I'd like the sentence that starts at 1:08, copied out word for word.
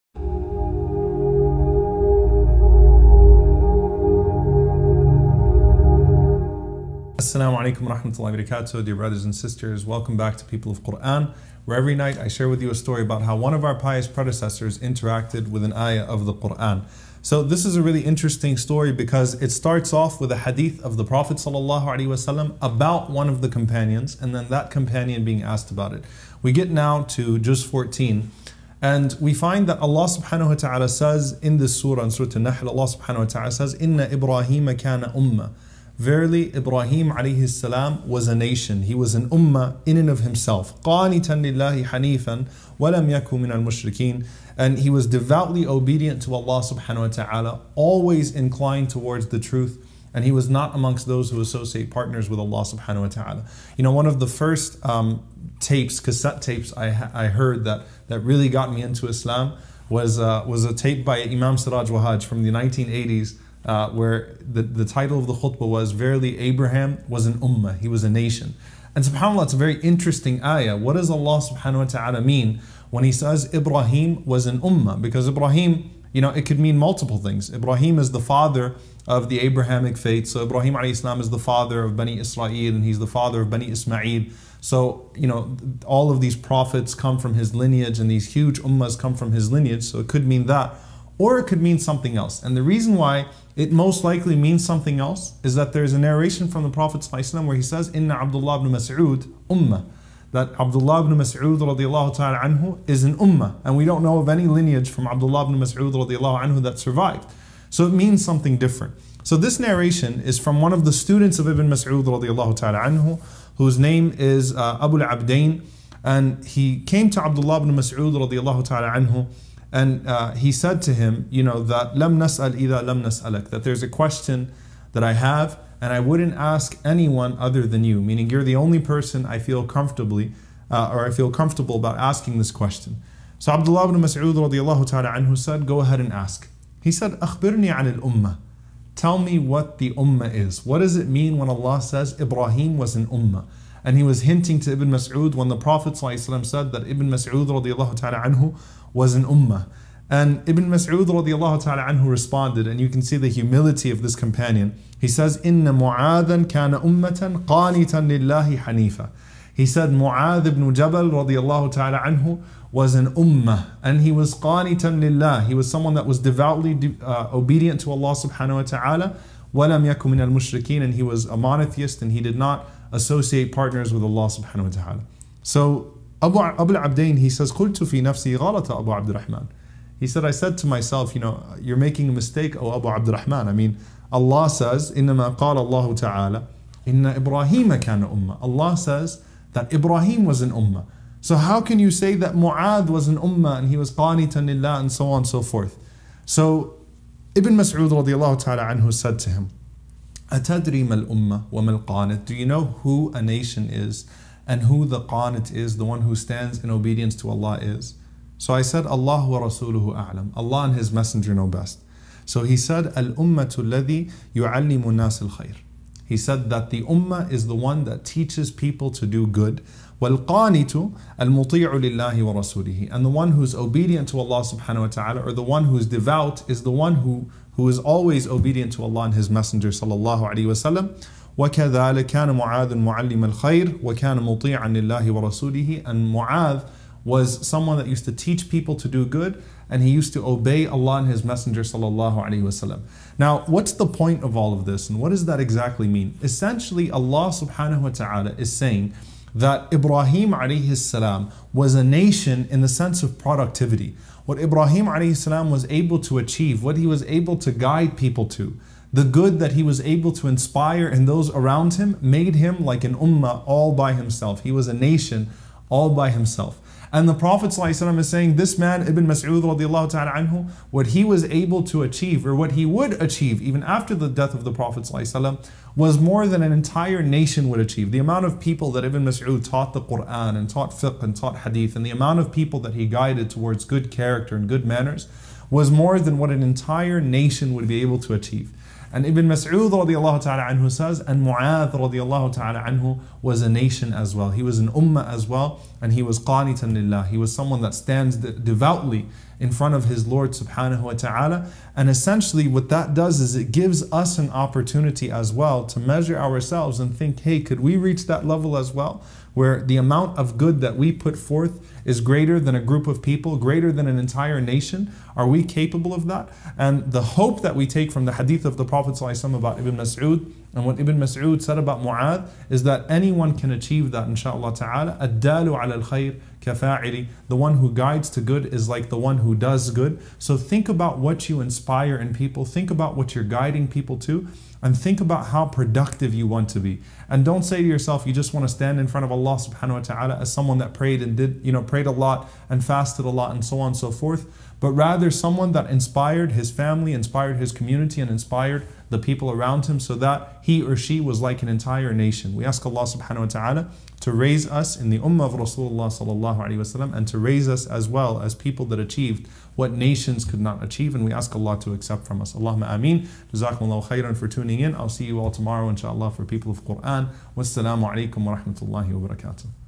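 And subhanAllah, it's a very interesting ayah.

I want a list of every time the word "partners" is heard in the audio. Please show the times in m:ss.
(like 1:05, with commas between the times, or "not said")
0:51, 2:53.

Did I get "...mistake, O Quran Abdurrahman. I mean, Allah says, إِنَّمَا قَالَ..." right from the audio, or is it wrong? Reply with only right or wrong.
wrong.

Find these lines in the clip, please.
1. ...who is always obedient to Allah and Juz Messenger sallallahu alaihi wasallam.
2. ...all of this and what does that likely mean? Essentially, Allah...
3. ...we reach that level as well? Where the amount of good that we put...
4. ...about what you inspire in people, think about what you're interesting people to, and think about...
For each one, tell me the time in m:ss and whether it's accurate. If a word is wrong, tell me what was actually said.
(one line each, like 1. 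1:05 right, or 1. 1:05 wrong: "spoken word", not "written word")
1. 3:47 wrong: "His", not "Juz"
2. 4:04 wrong: "exactly", not "likely"
3. 5:07 right
4. 5:30 wrong: "guiding", not "interesting".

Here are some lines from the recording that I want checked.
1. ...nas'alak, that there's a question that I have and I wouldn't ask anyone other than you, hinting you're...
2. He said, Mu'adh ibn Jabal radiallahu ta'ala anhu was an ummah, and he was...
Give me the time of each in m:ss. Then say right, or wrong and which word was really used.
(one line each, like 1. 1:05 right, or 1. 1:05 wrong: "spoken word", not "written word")
1. 2:03 wrong: "meaning", not "hinting"
2. 2:39 right.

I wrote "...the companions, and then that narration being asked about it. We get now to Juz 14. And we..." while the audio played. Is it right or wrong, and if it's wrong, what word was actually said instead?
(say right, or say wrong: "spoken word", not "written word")
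wrong: "companion", not "narration".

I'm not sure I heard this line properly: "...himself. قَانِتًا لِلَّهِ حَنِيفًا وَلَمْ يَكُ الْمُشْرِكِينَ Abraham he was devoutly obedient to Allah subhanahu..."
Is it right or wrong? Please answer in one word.
wrong.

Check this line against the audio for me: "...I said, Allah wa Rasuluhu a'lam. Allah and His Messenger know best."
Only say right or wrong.
right.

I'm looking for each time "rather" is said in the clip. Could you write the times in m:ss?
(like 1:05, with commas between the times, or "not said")
5:44.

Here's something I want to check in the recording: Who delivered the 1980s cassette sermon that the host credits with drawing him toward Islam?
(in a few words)
Imam Siraj Wahaj.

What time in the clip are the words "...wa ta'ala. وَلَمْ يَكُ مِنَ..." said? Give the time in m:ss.
2:48.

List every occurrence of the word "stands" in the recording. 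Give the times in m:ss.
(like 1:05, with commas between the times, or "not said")
3:26, 4:57, 5:38.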